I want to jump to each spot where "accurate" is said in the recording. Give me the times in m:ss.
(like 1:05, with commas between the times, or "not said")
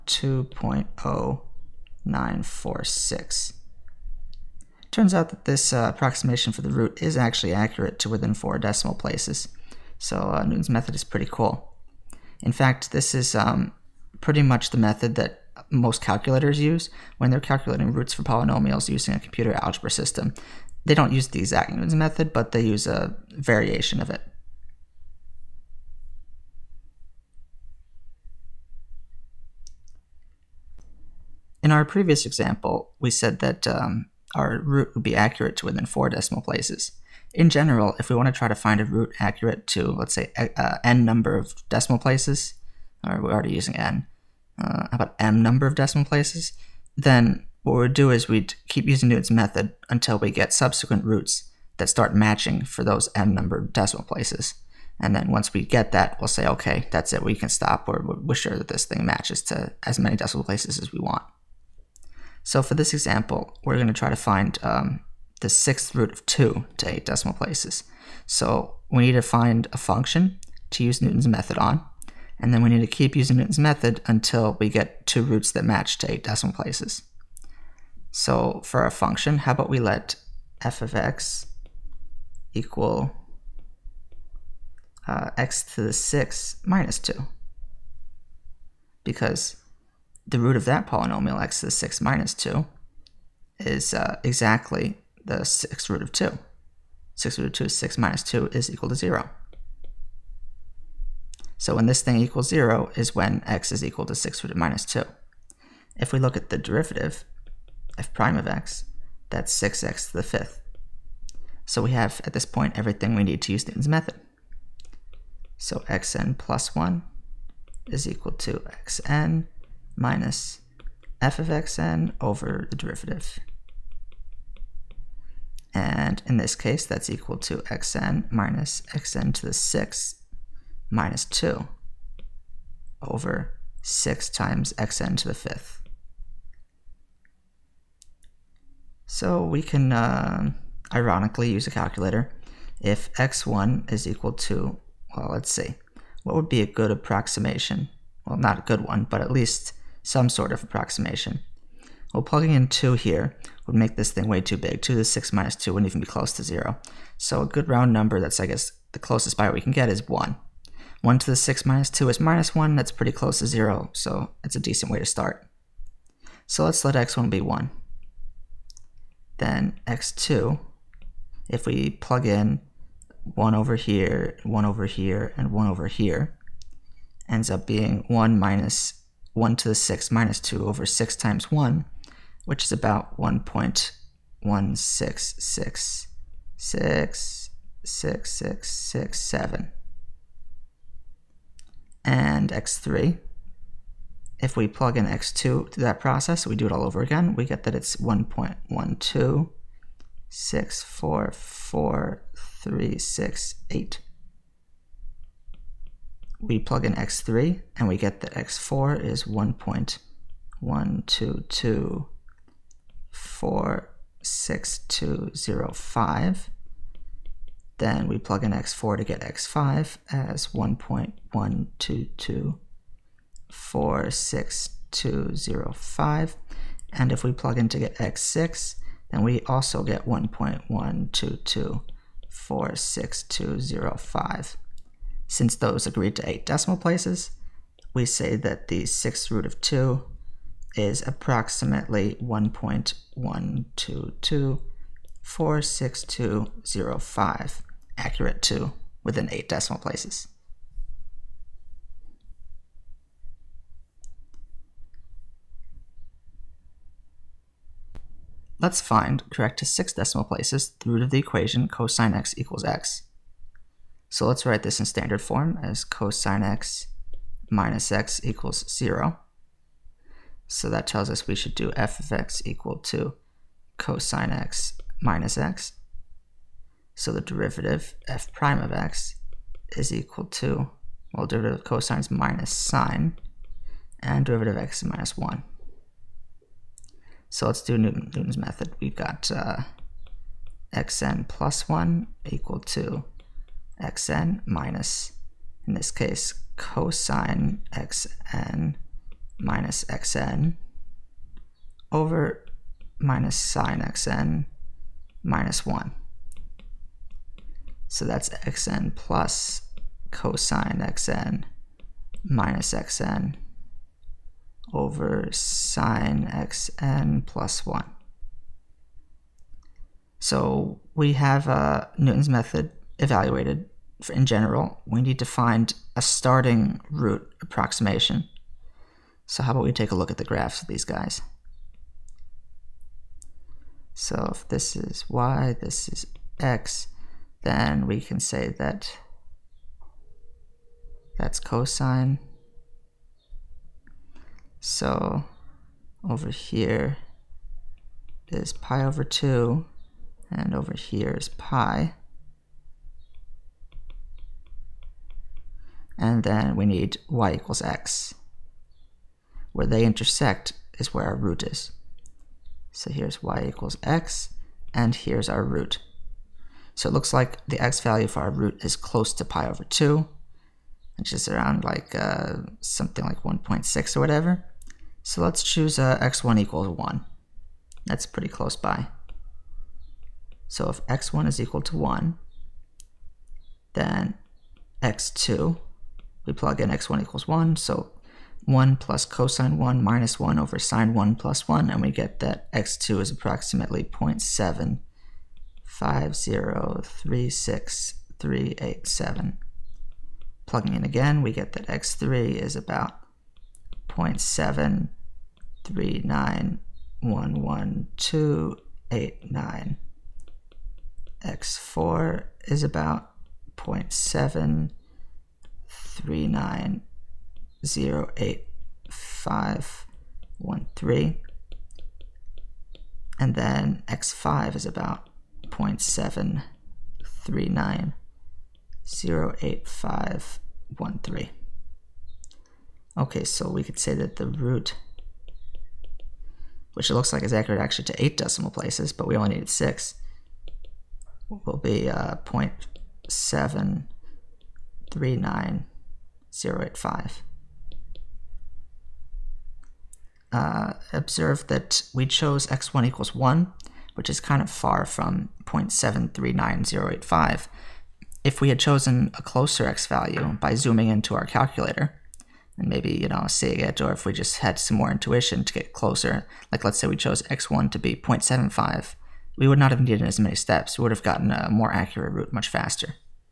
0:07, 0:35, 0:39, 4:08, 7:17, 7:51.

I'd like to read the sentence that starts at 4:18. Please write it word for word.
Let's find correct to six decimal places the root of the equation cosine x equals x.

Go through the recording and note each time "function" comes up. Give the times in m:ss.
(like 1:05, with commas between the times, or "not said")
1:09, 1:18.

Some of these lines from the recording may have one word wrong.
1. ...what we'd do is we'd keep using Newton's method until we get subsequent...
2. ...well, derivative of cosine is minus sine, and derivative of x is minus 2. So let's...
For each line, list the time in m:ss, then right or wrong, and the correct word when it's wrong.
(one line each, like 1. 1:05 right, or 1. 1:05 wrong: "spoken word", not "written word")
1. 0:47 right
2. 4:41 wrong: "1", not "2".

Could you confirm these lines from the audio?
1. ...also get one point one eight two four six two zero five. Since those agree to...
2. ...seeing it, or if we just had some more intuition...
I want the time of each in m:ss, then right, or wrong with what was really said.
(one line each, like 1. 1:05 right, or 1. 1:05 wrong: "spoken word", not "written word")
1. 3:49 wrong: "two", not "eight"
2. 7:43 right.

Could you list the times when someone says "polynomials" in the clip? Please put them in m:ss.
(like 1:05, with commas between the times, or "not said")
0:18, 1:30.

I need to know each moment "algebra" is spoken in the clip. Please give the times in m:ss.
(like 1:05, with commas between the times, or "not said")
0:19.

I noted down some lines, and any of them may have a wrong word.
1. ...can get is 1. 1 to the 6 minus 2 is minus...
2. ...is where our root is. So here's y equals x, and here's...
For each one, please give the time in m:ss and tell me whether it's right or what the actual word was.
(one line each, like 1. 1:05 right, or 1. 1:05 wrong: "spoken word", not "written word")
1. 2:39 right
2. 6:00 right.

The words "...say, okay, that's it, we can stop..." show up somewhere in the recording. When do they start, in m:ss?
0:56.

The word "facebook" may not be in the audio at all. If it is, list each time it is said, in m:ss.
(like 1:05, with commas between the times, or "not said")
not said.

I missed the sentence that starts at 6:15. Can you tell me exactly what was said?
So let's choose uh, x1 equals 1.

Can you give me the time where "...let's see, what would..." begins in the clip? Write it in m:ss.
2:25.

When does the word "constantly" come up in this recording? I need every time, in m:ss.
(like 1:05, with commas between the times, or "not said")
not said.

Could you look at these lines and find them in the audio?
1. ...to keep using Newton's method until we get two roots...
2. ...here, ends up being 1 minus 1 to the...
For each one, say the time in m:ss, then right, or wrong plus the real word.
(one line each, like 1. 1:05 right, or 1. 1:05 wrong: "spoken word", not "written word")
1. 1:12 right
2. 2:55 right.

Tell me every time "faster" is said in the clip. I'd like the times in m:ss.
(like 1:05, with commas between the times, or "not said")
7:52.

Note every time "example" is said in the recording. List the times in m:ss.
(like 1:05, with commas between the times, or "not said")
0:32, 1:02.